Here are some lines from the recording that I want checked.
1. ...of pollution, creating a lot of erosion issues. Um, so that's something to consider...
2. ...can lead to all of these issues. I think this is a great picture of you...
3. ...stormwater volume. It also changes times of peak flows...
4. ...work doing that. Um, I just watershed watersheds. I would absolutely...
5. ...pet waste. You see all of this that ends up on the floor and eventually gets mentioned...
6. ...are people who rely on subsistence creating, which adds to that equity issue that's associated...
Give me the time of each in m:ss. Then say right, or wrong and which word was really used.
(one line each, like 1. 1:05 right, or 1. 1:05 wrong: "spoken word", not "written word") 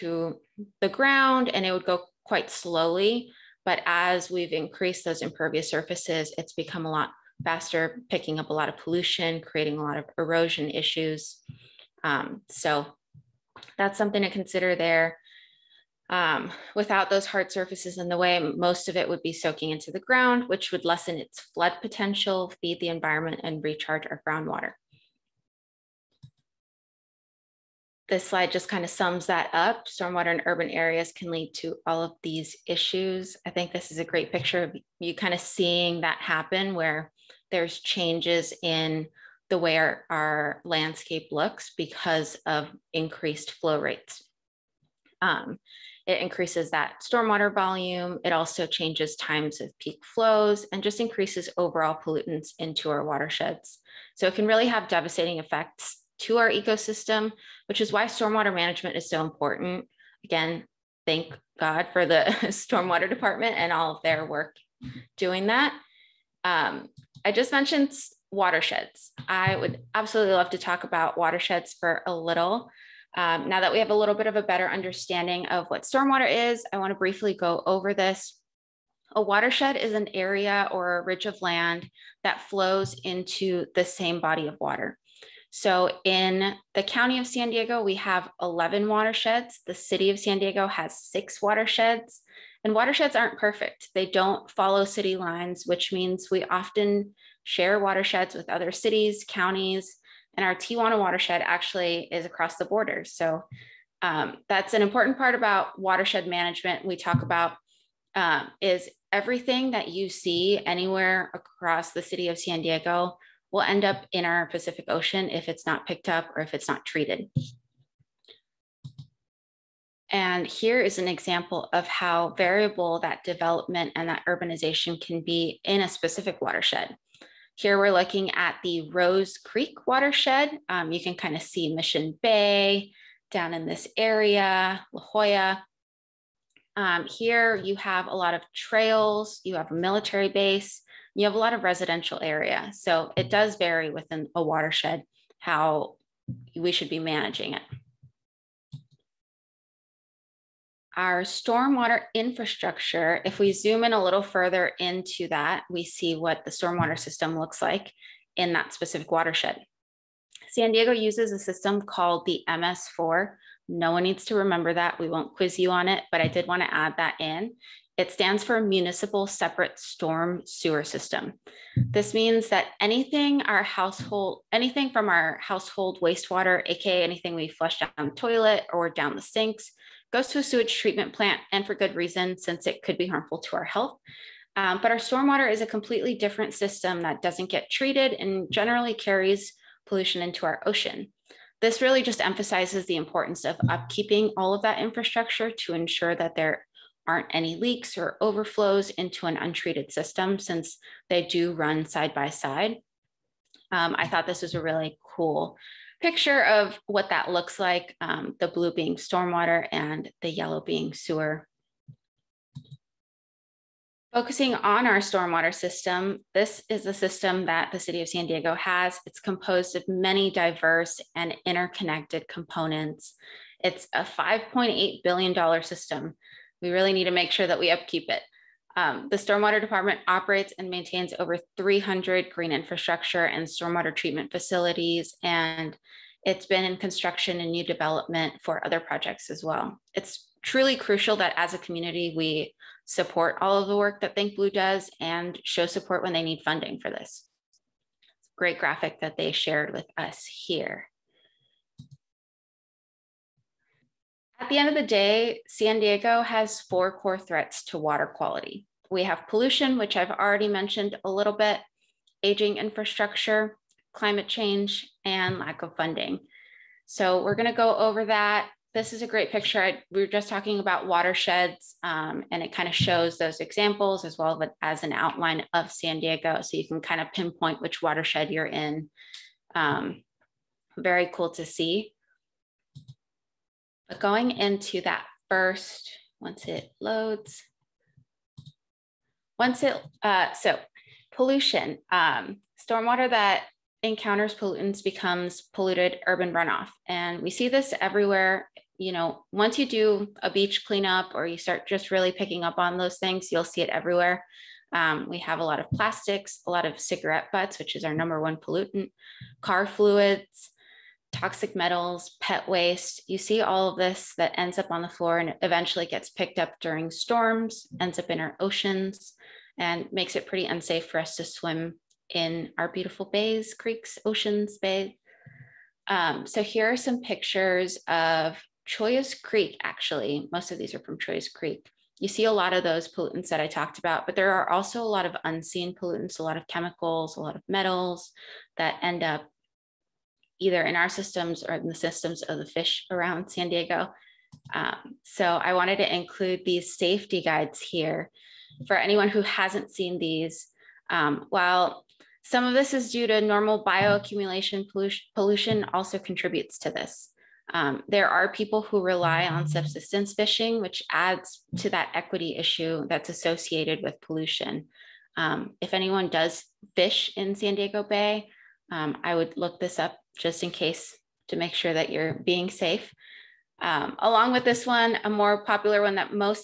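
1. 0:08 right
2. 0:31 right
3. 0:47 right
4. 1:04 wrong: "mentioned", not "watershed"
5. 5:12 wrong: "picked", not "mentioned"
6. 5:58 wrong: "fishing", not "creating".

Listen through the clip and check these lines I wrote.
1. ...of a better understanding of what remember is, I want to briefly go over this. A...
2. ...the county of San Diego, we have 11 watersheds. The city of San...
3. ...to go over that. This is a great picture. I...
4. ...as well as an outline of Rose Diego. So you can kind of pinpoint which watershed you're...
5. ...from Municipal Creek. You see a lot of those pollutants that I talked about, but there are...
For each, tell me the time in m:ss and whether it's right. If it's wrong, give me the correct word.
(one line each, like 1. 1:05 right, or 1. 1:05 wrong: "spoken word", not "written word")
1. 1:14 wrong: "stormwater", not "remember"
2. 1:26 right
3. 4:27 right
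4. 4:34 wrong: "San", not "Rose"
5. 5:30 wrong: "Chollas", not "Municipal".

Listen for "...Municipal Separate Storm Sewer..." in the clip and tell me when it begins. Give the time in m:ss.
2:48.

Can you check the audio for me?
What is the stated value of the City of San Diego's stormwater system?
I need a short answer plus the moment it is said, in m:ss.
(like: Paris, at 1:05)
$5.8 billion, at 3:44.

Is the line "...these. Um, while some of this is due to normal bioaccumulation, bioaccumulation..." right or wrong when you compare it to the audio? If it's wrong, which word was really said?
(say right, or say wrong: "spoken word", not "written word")
wrong: "pollution", not "bioaccumulation".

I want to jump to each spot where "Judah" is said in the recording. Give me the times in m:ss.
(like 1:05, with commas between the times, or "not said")
not said.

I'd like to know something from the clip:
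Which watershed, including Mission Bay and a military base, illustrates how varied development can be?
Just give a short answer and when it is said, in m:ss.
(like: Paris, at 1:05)
Rose Creek, at 2:08.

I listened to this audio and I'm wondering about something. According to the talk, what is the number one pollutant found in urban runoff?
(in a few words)
cigarette butts.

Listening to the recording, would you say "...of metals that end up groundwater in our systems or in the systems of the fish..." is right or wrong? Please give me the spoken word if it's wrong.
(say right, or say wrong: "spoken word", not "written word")
wrong: "either", not "groundwater".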